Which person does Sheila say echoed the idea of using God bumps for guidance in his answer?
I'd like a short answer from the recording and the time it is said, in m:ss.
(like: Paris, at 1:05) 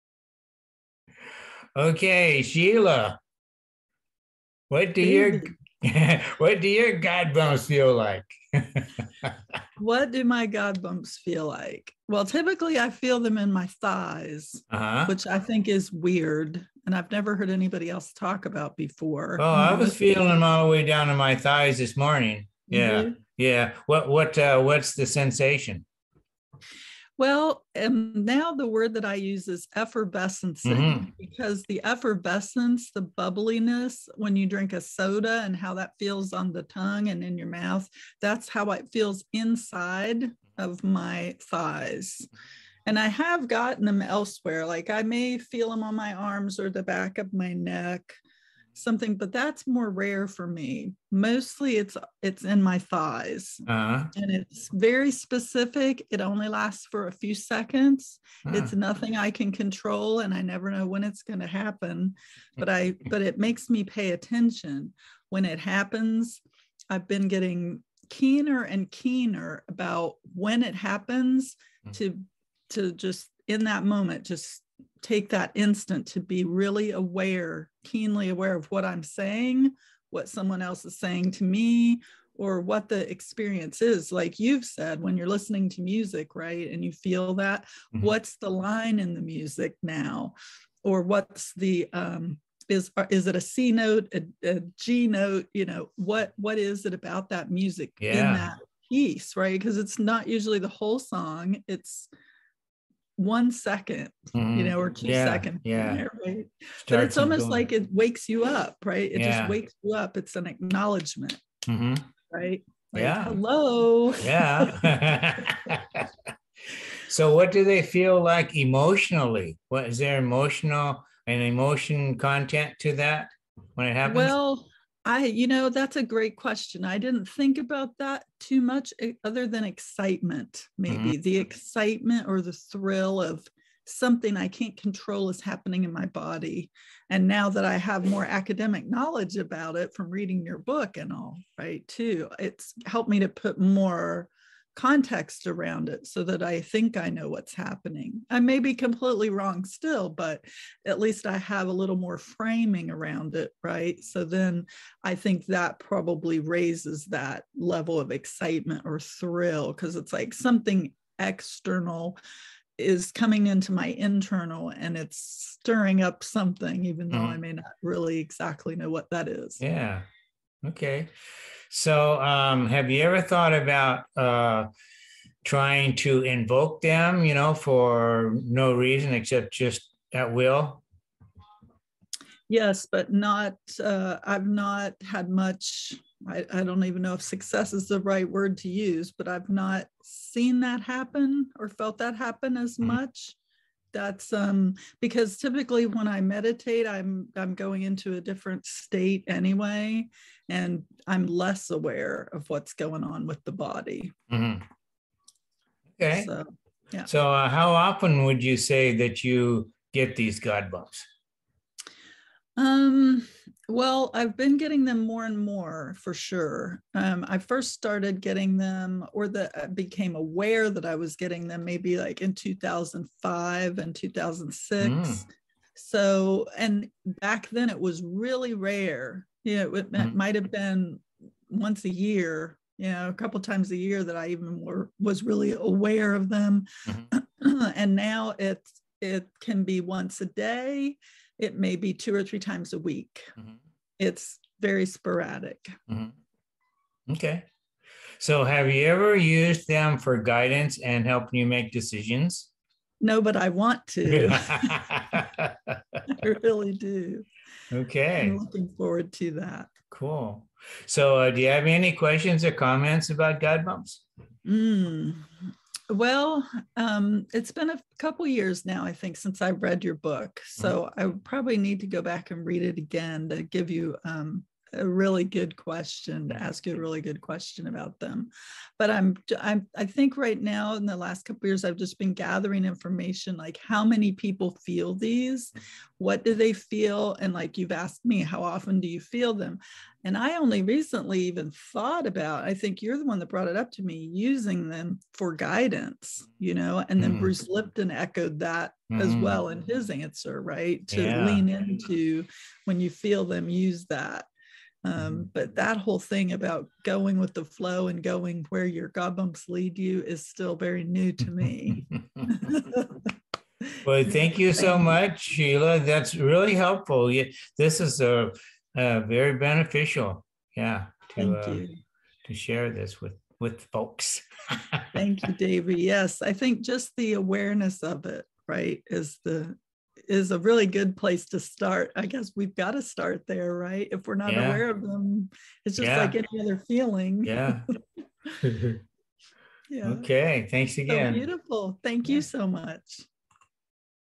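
Bruce Lipton, at 4:57.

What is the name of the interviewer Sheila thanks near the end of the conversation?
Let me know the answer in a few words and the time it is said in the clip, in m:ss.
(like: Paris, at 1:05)
Davie, at 5:25.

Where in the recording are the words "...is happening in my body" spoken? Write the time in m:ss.
2:15.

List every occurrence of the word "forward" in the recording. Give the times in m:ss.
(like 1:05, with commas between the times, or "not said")
4:18.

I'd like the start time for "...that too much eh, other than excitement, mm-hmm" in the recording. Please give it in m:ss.
2:07.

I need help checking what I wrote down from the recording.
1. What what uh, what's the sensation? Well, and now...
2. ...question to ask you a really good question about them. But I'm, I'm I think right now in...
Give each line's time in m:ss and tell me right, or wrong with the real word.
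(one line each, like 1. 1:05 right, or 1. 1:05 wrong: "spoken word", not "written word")
1. 0:23 right
2. 4:35 right.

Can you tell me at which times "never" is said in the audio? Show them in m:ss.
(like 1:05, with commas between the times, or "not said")
0:17, 1:00.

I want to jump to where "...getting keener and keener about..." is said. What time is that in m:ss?
1:07.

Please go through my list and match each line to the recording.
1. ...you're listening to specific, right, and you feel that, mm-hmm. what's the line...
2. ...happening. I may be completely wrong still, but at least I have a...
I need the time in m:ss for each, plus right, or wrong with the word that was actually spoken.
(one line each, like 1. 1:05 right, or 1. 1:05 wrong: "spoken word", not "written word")
1. 1:25 wrong: "music", not "specific"
2. 2:27 right.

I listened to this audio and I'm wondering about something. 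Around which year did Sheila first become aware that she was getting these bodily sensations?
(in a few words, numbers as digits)
2005.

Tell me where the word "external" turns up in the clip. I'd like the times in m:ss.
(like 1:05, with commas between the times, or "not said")
2:41.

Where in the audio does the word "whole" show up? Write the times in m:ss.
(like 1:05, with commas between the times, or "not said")
1:40, 5:05.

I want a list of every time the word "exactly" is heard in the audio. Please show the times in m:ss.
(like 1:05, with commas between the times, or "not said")
2:48.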